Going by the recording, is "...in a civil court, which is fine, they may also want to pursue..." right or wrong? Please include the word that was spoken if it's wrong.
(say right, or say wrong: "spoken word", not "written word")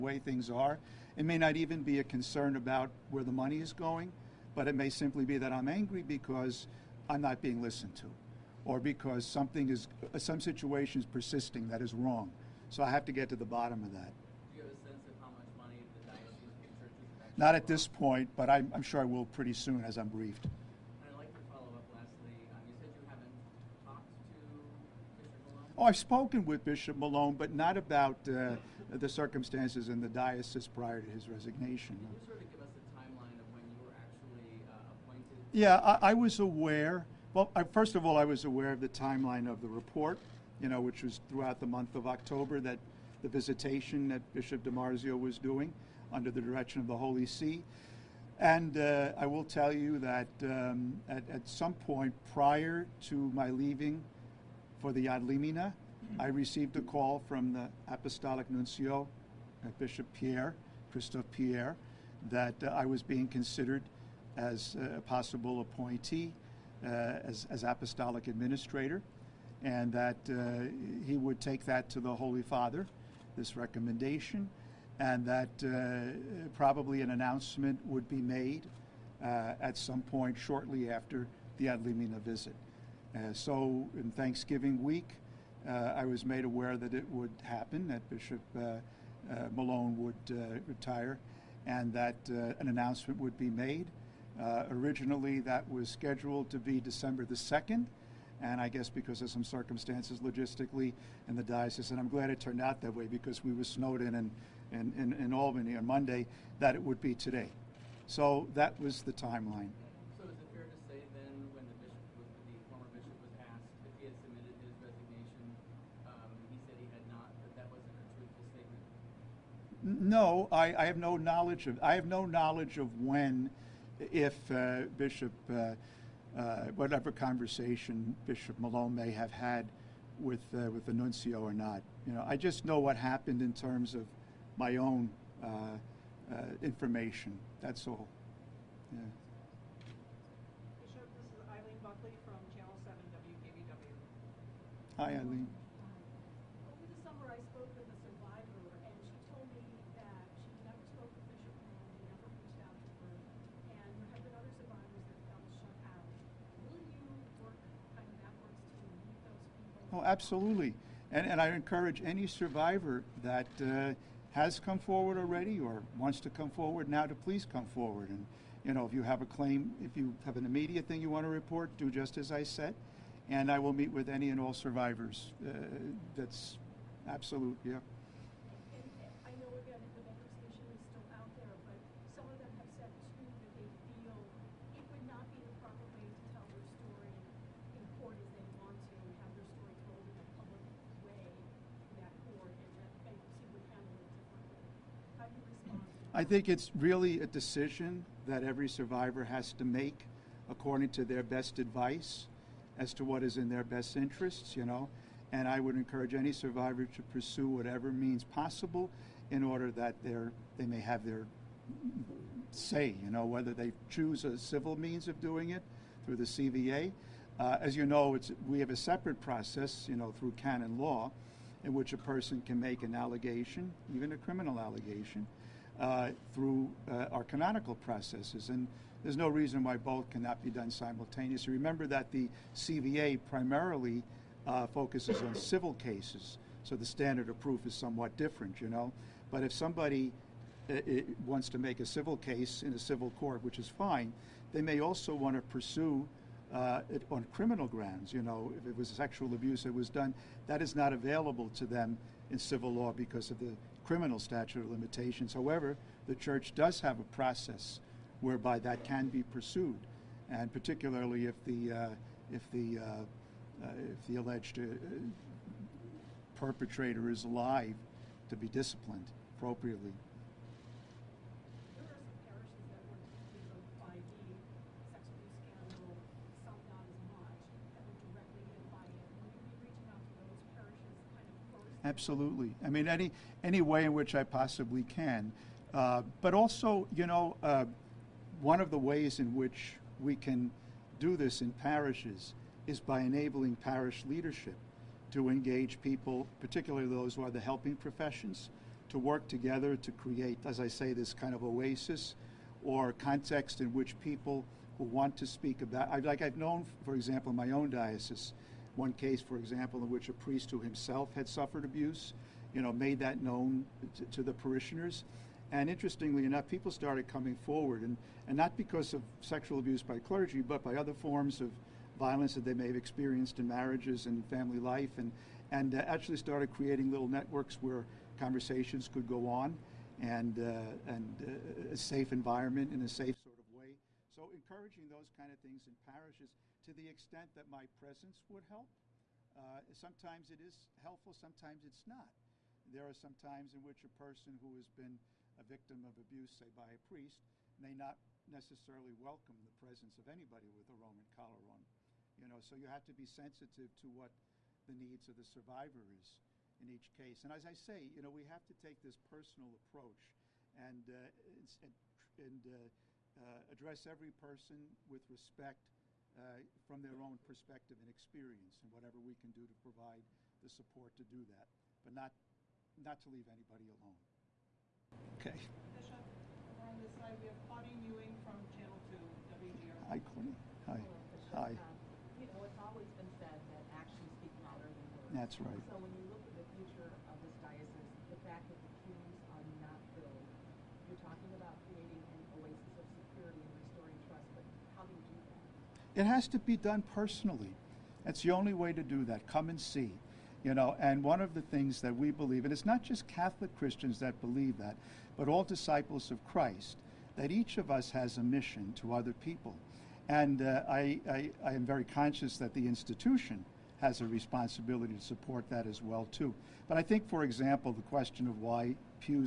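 right.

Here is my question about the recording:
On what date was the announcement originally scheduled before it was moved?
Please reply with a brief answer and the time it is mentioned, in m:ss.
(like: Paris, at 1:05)
December 2, at 1:36.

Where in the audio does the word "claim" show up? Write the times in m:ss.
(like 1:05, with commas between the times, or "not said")
2:49.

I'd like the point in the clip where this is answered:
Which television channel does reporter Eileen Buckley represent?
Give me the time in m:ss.
2:22.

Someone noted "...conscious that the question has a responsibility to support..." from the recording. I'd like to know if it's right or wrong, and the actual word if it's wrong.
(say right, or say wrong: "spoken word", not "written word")
wrong: "institution", not "question".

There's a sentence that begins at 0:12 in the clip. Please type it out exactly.
So I have to get to the bottom of that.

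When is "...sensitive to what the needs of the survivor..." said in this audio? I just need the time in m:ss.
5:53.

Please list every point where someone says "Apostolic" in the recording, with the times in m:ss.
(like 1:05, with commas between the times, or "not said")
0:57, 1:07.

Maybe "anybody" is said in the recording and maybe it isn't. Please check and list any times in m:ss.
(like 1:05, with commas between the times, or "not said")
5:50, 6:13.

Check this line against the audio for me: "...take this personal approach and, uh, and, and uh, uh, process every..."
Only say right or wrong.
wrong.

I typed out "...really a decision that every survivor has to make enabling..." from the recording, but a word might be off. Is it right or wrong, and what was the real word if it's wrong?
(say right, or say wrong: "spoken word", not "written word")
wrong: "according", not "enabling".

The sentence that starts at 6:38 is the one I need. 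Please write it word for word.
That's the only way to do that.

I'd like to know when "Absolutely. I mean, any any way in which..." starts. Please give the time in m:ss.
4:41.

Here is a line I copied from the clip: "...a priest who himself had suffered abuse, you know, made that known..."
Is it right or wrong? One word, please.
right.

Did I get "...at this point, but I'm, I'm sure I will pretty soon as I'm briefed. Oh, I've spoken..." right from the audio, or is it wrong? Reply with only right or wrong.
right.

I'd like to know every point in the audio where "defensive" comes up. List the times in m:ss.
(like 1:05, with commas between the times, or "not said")
not said.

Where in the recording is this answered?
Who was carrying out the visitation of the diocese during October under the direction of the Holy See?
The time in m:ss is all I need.
0:44.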